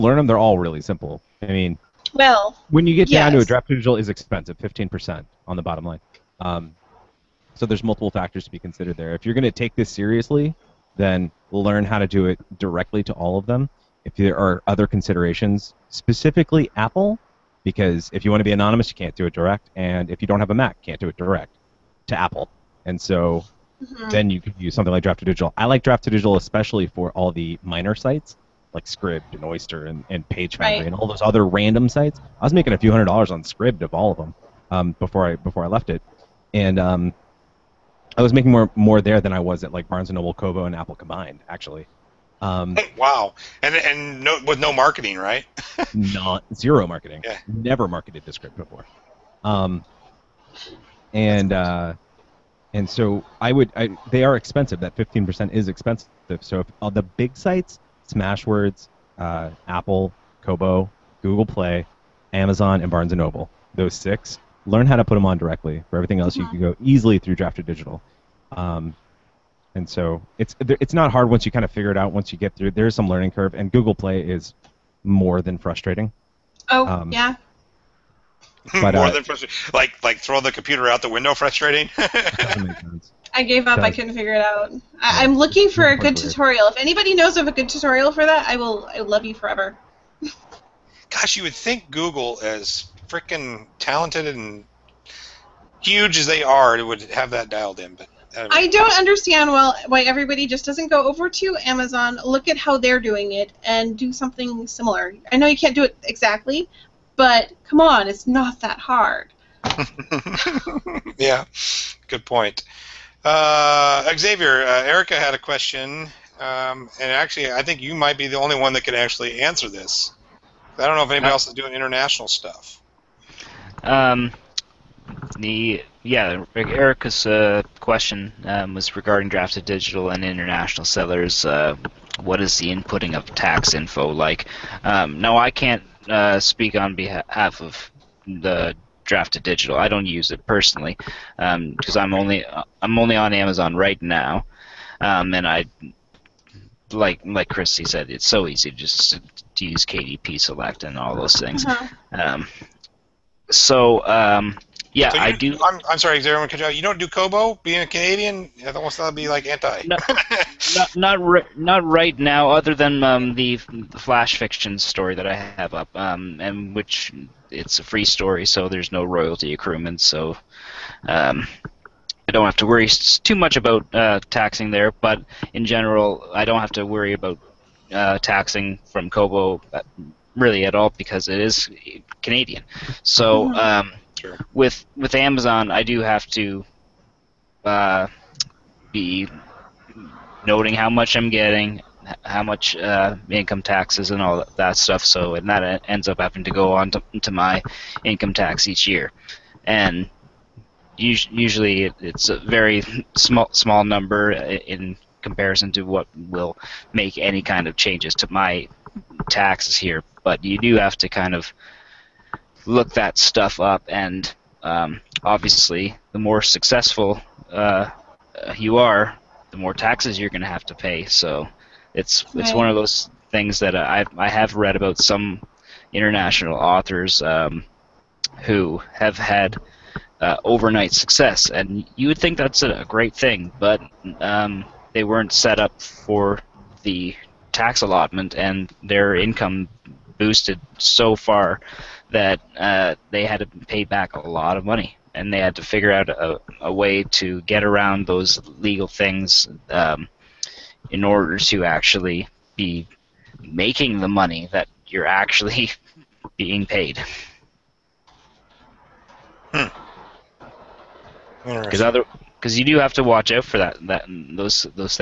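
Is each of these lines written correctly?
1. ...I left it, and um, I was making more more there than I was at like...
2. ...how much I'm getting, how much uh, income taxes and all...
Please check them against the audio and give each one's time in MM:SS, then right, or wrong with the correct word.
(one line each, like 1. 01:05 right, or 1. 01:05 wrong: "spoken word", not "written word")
1. 00:35 right
2. 03:10 right.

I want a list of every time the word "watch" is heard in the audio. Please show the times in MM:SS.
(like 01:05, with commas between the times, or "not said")
04:23.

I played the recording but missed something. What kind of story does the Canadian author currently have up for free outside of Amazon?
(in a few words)
Flash fiction.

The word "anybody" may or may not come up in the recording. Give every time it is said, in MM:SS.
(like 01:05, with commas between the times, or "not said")
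01:26, 02:01.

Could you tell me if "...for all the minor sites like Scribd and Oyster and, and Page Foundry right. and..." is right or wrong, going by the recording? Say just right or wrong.
right.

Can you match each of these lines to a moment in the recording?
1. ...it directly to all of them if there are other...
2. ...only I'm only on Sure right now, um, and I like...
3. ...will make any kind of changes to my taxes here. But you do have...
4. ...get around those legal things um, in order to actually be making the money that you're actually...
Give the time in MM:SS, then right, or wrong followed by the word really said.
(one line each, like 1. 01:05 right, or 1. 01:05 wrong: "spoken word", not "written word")
1. 00:12 right
2. 02:22 wrong: "Amazon", not "Sure"
3. 03:26 right
4. 04:07 right.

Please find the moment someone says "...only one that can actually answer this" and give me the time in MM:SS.
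01:58.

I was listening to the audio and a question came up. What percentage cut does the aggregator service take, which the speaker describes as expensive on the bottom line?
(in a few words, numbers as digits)
15%.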